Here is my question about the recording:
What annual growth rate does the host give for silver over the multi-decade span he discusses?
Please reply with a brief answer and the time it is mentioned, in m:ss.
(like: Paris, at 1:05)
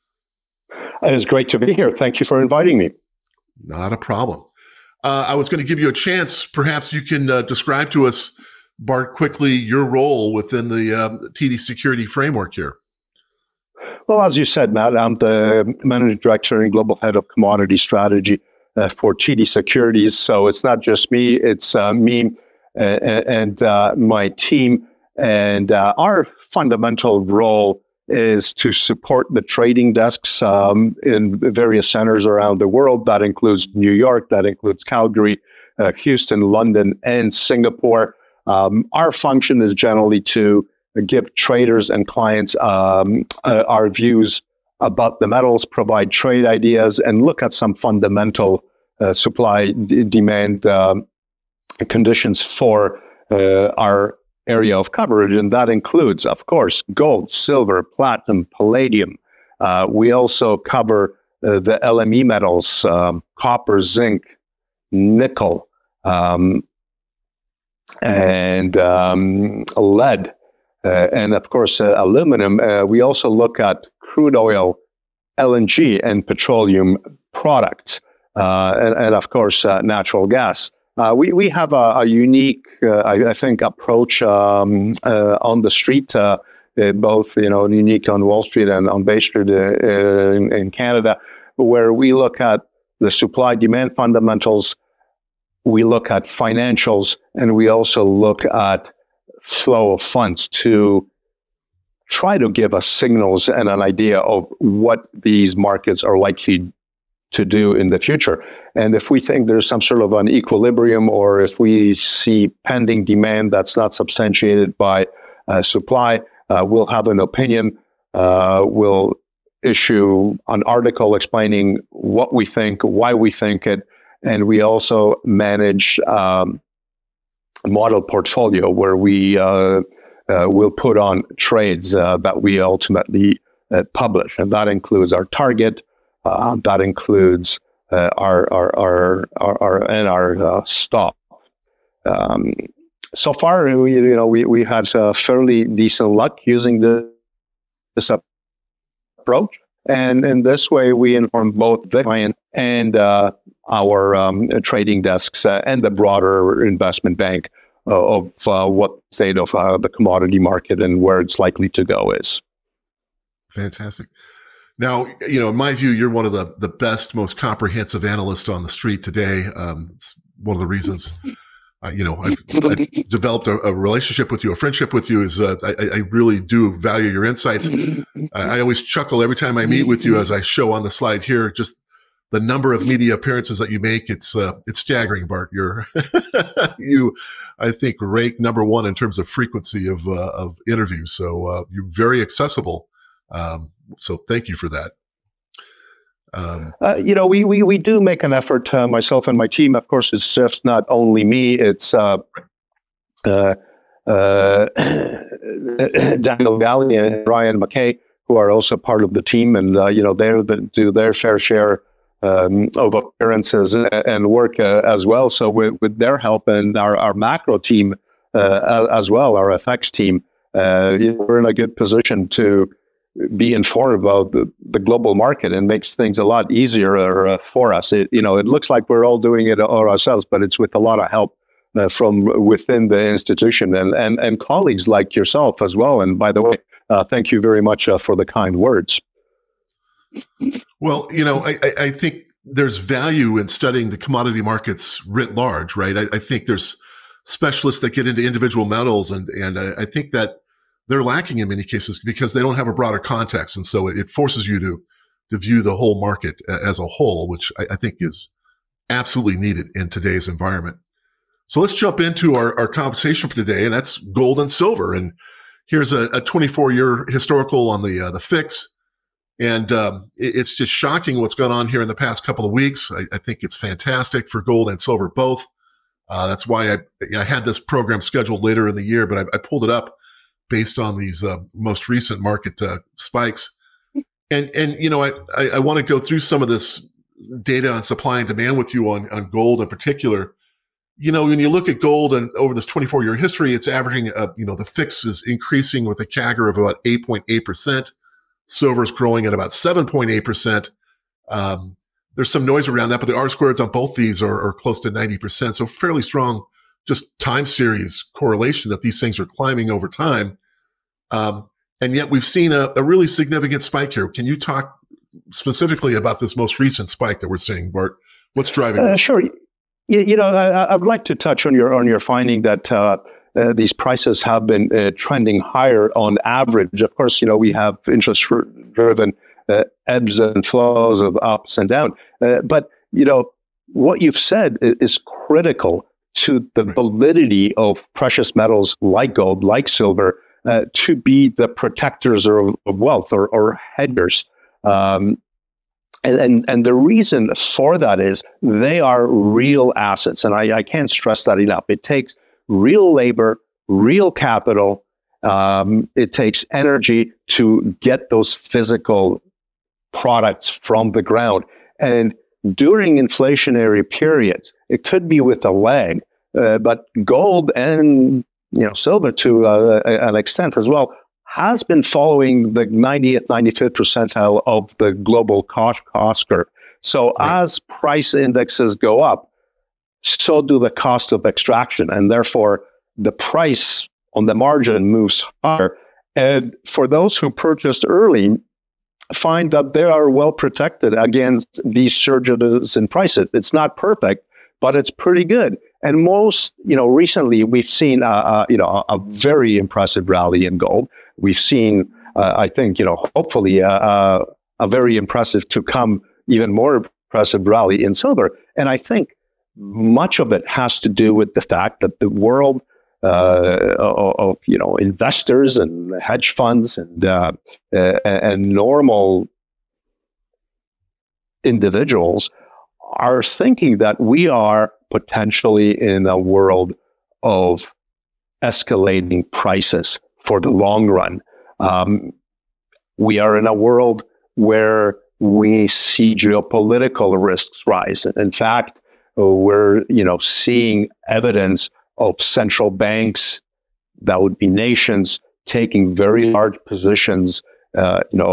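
7.8%, at 4:59.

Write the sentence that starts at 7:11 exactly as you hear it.
Um, we are in a world where we see geopolitical risks rise.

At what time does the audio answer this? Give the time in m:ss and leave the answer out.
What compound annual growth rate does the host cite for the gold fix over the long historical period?
4:56.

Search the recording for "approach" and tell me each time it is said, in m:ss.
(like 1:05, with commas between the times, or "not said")
1:23, 2:29.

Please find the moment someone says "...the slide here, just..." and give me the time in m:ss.
3:00.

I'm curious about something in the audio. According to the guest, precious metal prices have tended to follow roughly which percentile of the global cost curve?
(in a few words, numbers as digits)
90th, 95th.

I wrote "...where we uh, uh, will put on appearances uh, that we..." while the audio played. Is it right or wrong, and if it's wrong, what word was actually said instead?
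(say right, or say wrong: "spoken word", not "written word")
wrong: "trades", not "appearances".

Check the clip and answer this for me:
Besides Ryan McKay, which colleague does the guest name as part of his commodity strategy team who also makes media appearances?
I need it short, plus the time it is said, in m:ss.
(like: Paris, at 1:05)
Daniel Ghali, at 3:26.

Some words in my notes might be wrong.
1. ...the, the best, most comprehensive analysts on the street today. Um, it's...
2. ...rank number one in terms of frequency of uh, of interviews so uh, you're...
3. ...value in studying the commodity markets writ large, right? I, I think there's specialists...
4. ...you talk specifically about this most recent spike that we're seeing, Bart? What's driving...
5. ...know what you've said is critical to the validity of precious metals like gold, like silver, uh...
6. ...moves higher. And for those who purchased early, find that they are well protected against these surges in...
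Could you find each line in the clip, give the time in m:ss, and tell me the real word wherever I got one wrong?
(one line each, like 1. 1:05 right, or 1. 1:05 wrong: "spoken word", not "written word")
1. 2:46 right
2. 3:07 right
3. 4:02 right
4. 5:14 right
5. 5:33 right
6. 6:24 right.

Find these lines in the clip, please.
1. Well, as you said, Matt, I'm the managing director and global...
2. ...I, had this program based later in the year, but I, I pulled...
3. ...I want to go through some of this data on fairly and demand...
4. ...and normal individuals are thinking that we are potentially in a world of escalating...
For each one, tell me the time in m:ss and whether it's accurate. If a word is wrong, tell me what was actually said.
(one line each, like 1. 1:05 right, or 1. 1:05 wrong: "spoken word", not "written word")
1. 0:14 right
2. 4:37 wrong: "scheduled", not "based"
3. 4:45 wrong: "supply", not "fairly"
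4. 6:58 right.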